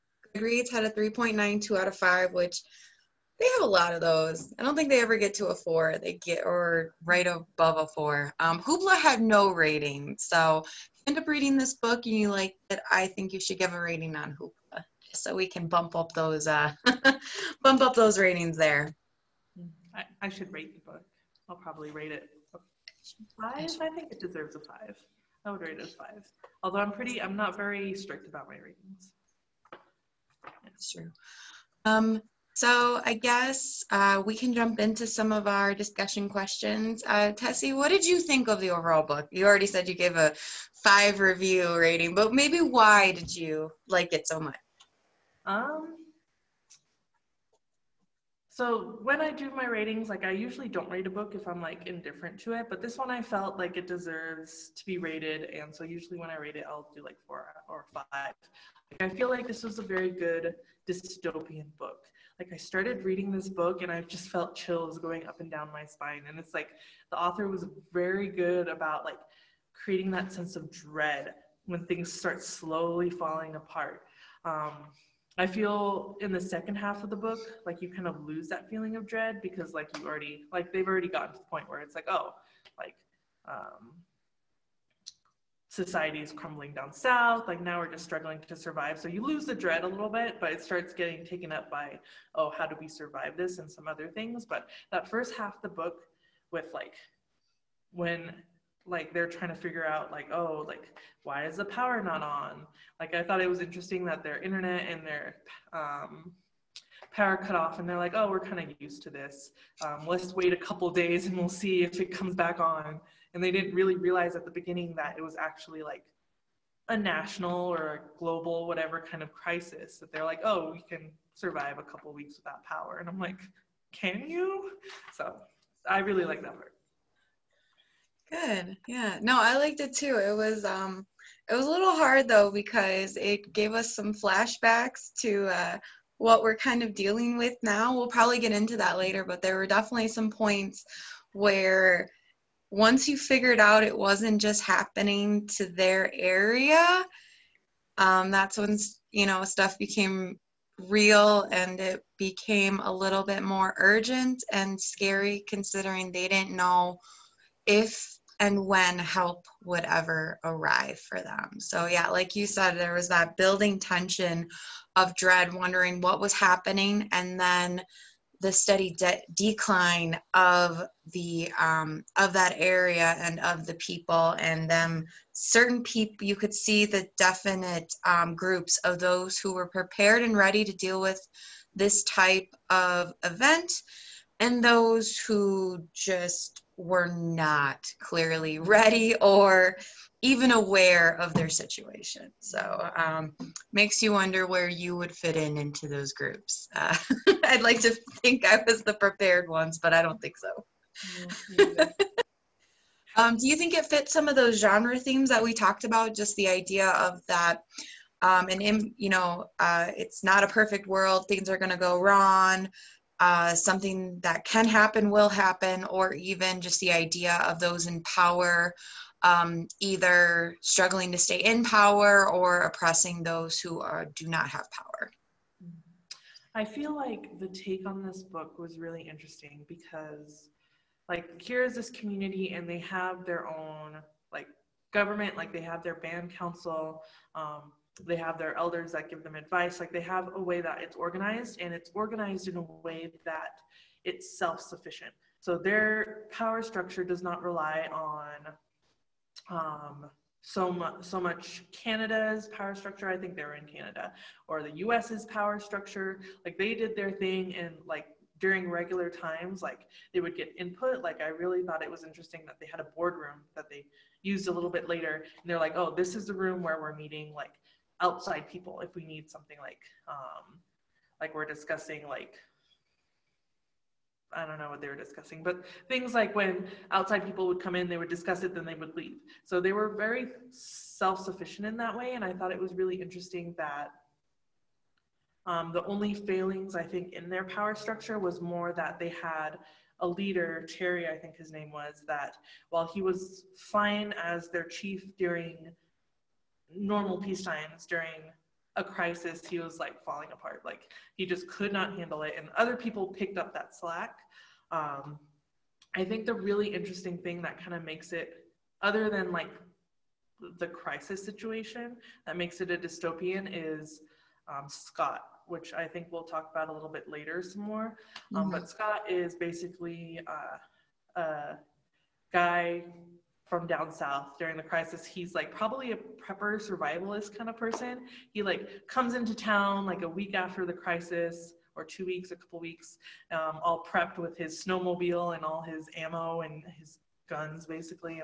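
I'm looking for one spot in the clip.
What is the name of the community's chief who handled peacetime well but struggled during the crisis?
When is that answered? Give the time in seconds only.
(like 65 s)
290 s.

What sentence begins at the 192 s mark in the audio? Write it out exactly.
So um, makes you wonder where you would fit in into those groups.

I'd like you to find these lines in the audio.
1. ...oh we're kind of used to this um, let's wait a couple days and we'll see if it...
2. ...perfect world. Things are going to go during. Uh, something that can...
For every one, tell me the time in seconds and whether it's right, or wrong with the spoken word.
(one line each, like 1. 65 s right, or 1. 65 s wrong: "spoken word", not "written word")
1. 108 s right
2. 210 s wrong: "wrong", not "during".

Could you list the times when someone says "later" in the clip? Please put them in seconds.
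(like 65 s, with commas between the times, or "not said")
138 s, 264 s, 317 s.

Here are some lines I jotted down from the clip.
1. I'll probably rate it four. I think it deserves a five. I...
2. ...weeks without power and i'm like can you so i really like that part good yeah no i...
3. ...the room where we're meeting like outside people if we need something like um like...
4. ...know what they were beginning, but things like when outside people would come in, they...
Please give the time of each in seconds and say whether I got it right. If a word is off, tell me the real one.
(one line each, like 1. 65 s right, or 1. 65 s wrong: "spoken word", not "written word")
1. 21 s wrong: "five", not "four"
2. 122 s right
3. 266 s right
4. 274 s wrong: "discussing", not "beginning".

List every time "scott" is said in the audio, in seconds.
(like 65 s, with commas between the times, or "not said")
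314 s, 318 s.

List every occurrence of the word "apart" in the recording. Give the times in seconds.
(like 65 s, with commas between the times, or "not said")
73 s, 300 s.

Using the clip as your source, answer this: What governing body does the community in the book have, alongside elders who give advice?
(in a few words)
band council.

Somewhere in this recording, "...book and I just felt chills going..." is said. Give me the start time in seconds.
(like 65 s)
63 s.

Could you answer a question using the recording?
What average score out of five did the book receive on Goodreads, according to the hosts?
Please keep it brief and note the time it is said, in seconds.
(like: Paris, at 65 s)
3.92, at 0 s.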